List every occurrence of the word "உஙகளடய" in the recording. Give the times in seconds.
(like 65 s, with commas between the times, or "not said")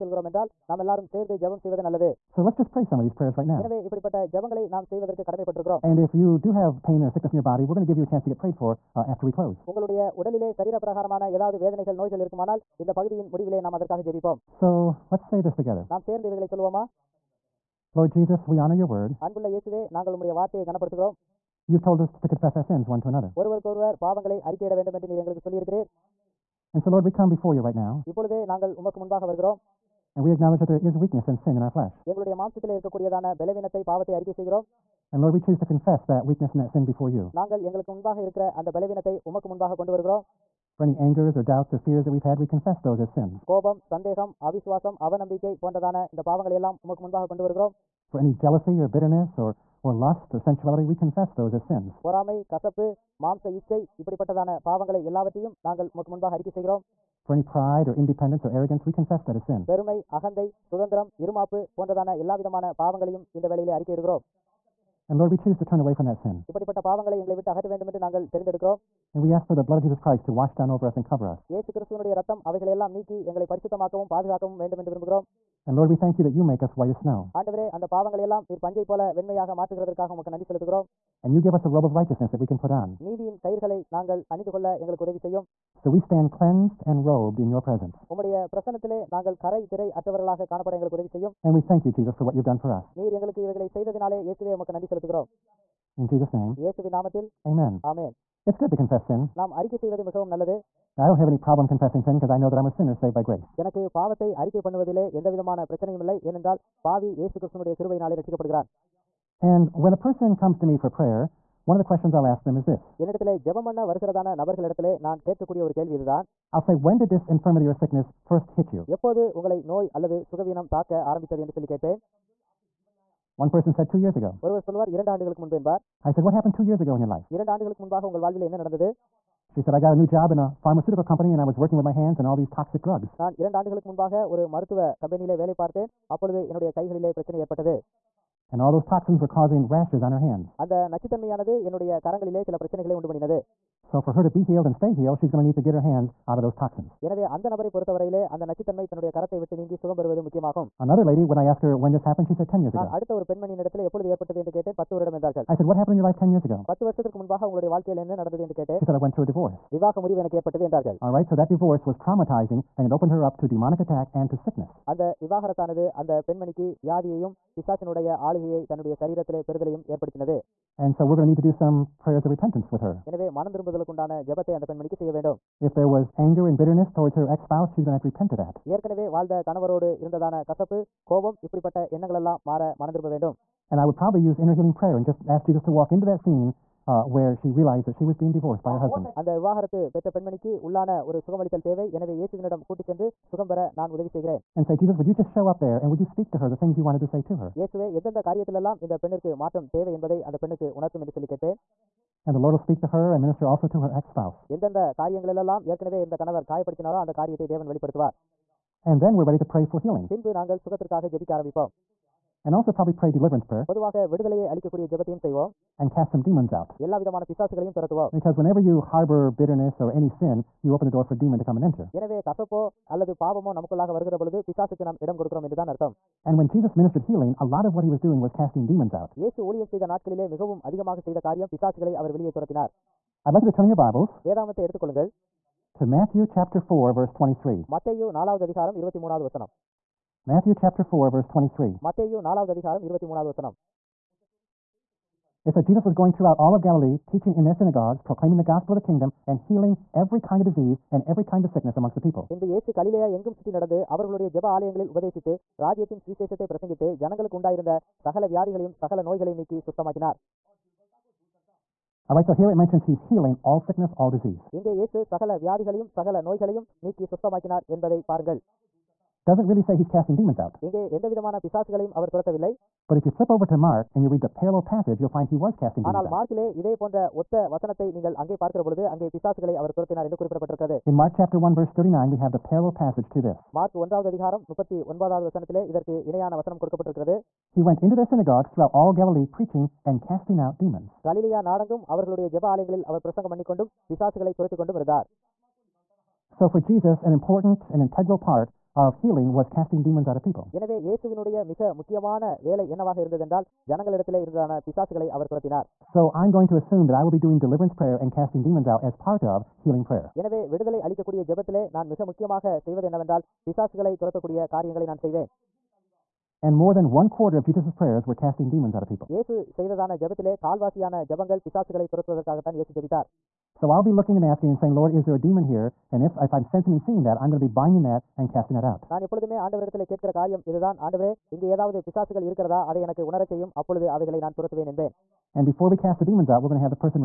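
9 s, 157 s.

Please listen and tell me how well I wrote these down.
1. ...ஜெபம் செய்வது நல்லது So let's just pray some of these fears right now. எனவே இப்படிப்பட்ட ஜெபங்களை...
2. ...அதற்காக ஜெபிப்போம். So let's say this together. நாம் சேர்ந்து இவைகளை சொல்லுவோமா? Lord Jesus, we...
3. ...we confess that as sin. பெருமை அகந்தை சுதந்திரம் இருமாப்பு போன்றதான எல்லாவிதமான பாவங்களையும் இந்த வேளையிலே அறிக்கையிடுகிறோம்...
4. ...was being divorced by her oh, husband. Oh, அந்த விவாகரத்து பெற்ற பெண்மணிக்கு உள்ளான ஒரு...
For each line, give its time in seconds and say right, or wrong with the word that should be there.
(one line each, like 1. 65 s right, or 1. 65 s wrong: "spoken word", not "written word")
1. 1 s wrong: "prayers", not "fears"
2. 13 s right
3. 58 s right
4. 188 s right.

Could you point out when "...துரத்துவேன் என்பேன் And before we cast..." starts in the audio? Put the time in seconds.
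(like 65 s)
334 s.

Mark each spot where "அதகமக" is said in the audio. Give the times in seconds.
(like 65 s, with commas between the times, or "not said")
230 s.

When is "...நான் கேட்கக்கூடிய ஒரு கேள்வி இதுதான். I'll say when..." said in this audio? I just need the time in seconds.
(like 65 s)
115 s.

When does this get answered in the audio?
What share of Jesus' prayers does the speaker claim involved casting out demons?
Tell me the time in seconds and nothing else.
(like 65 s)
316 s.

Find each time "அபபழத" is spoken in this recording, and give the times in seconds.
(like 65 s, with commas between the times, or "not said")
136 s, 333 s.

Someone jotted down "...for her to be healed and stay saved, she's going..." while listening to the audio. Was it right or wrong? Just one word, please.
wrong.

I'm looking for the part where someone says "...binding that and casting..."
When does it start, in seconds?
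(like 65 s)
327 s.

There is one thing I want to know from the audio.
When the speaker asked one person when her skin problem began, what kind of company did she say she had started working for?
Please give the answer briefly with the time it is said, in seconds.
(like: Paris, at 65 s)
pharmaceutical company, at 130 s.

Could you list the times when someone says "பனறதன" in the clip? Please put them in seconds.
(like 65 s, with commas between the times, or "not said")
45 s, 61 s.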